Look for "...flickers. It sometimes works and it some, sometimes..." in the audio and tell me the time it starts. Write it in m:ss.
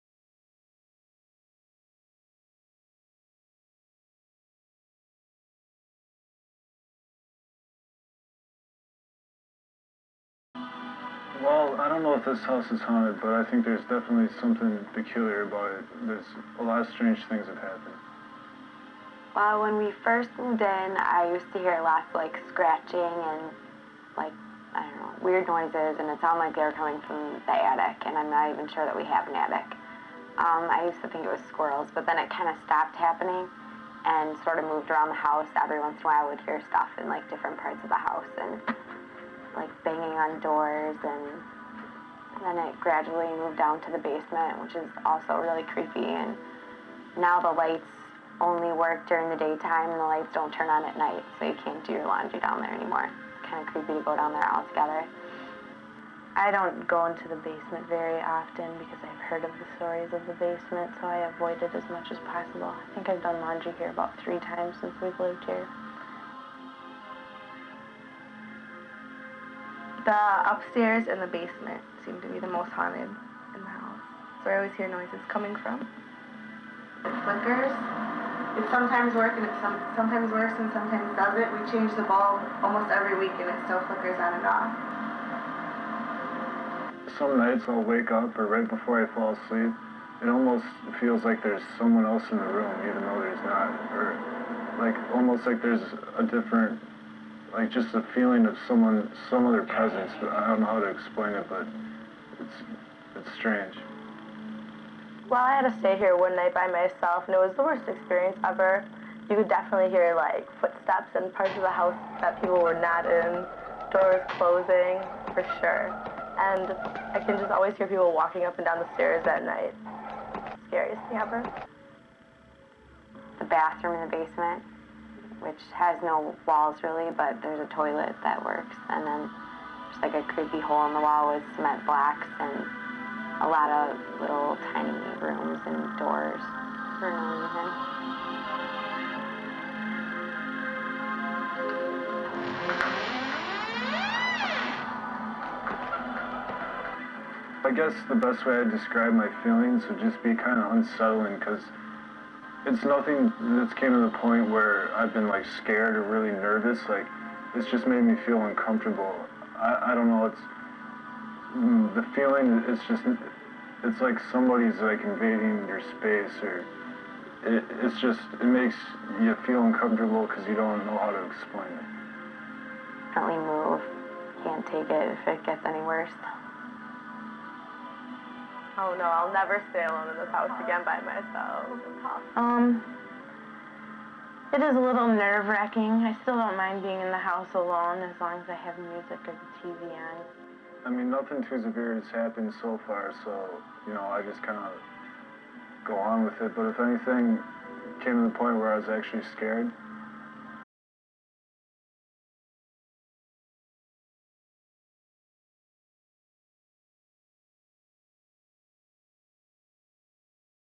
1:17.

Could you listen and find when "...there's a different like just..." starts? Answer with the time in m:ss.
1:35.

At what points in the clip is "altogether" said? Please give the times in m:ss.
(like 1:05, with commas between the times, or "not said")
0:54.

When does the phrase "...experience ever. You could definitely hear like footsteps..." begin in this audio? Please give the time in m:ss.
1:47.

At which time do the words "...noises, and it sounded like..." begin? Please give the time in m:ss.
0:25.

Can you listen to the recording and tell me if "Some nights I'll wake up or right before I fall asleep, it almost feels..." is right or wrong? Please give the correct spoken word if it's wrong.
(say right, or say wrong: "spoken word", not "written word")
right.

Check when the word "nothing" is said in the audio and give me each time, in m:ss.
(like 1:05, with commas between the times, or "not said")
2:32, 3:11.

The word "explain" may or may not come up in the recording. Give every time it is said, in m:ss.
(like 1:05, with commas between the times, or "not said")
1:40, 2:51.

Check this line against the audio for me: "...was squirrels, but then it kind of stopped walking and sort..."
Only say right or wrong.
wrong.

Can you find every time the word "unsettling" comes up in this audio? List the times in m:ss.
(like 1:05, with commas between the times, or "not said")
2:30.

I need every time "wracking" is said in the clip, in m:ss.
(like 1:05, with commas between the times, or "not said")
3:05.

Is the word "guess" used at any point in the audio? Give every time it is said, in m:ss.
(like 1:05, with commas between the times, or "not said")
2:27.